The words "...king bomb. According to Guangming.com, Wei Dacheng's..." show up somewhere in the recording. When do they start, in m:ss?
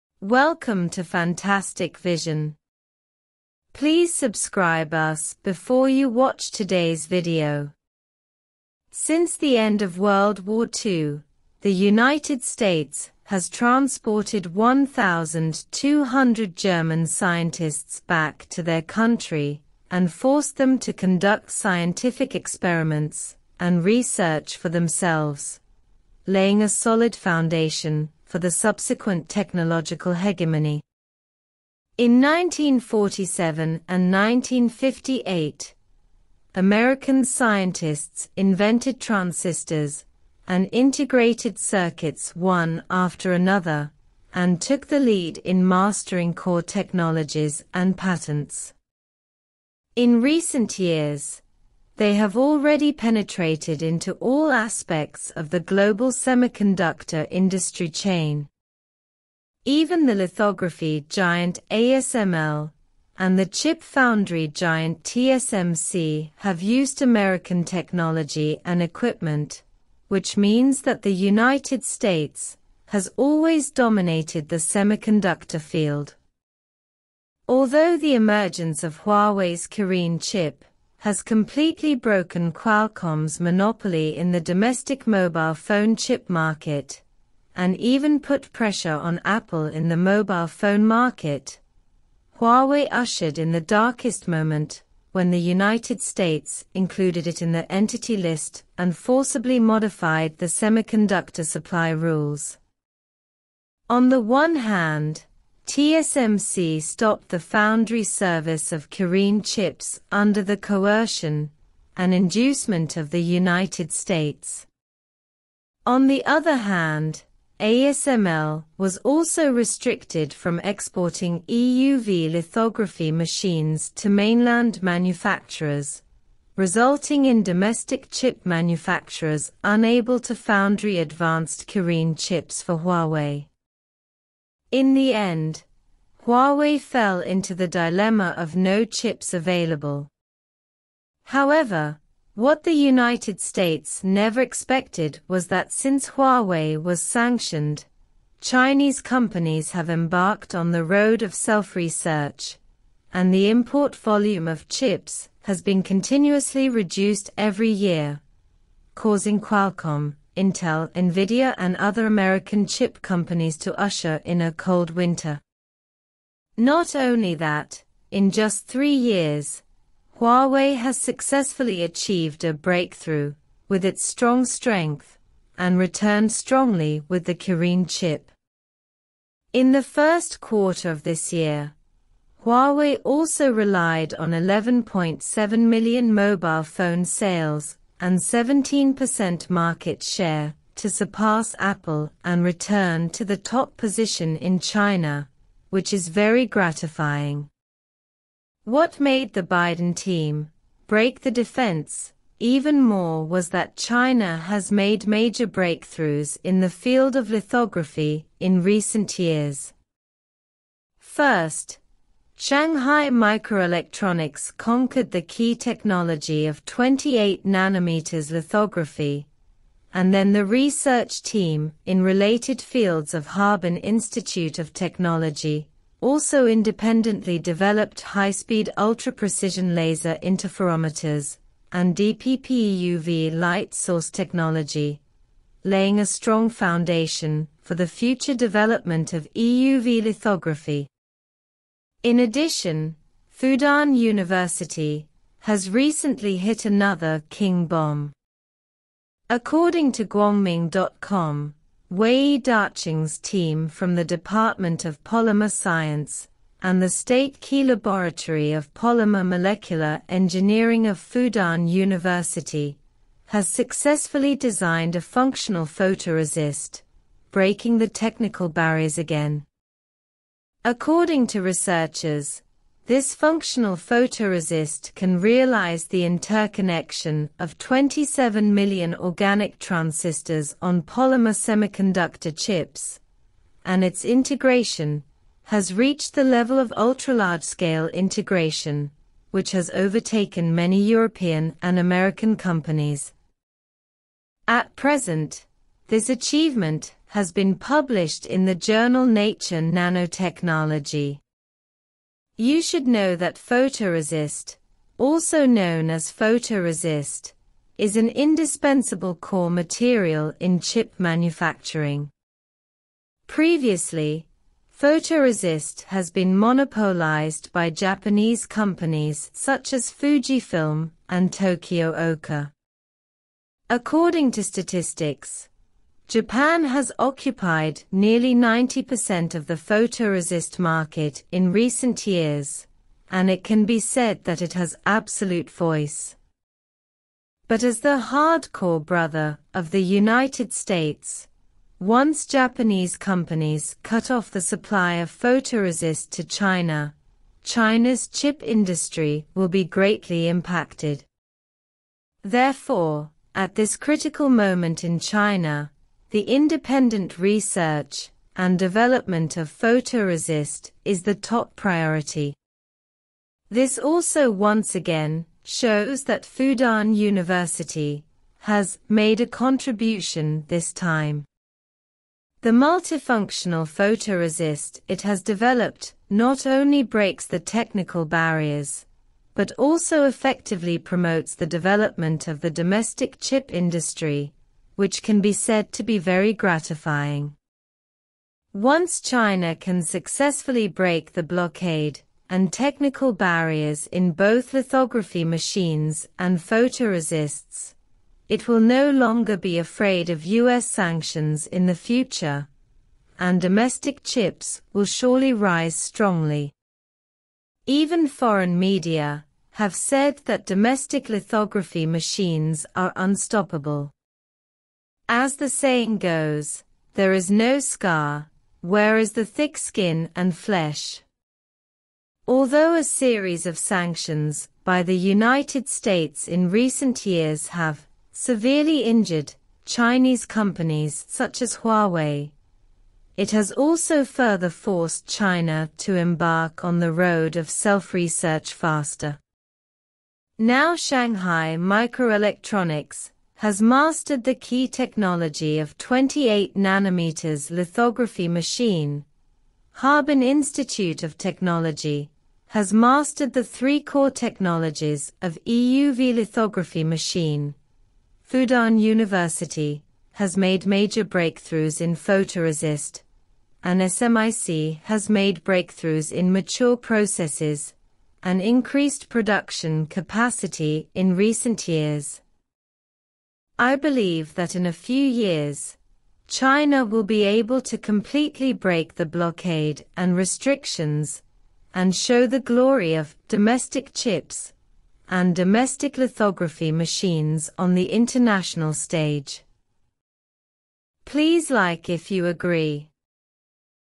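4:07.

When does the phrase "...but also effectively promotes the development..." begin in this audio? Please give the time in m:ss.
6:19.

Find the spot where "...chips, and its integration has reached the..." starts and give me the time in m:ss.
4:42.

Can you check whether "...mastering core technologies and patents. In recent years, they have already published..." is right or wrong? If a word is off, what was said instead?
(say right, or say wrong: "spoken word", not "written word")
wrong: "penetrated", not "published".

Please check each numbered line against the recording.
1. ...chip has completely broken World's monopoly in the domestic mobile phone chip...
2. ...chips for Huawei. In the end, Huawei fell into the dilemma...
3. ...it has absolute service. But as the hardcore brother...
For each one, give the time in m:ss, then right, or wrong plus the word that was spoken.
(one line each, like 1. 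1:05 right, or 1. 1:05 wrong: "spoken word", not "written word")
1. 1:20 wrong: "Qualcomm", not "World"
2. 2:12 right
3. 5:34 wrong: "voice", not "service".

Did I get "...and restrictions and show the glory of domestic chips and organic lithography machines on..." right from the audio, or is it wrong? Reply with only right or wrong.
wrong.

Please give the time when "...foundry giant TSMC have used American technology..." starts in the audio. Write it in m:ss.
1:03.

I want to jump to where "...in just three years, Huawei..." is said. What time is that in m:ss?
2:48.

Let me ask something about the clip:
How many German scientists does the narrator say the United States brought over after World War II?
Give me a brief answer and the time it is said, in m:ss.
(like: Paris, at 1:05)
1,200, at 0:14.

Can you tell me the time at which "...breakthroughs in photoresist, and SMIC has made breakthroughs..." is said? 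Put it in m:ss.
7:41.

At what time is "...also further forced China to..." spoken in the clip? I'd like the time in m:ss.
7:13.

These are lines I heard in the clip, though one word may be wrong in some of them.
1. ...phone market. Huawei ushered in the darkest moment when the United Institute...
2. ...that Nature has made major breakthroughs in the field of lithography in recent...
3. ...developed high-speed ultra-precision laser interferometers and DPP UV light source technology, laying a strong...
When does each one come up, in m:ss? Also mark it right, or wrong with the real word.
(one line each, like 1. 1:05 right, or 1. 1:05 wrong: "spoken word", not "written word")
1. 1:30 wrong: "States", not "Institute"
2. 3:23 wrong: "China", not "Nature"
3. 3:47 right.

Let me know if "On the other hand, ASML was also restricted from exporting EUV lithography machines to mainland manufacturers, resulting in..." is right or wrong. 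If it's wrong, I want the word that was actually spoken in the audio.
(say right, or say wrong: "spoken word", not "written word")
right.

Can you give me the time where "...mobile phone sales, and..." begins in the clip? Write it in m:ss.
3:06.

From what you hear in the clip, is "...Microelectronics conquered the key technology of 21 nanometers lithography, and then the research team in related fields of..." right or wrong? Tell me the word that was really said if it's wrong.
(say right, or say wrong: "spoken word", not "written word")
wrong: "28", not "21".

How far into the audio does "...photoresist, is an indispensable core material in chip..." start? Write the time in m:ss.
5:06.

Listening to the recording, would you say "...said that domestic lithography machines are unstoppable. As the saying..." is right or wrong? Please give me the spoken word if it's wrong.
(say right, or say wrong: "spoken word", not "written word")
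right.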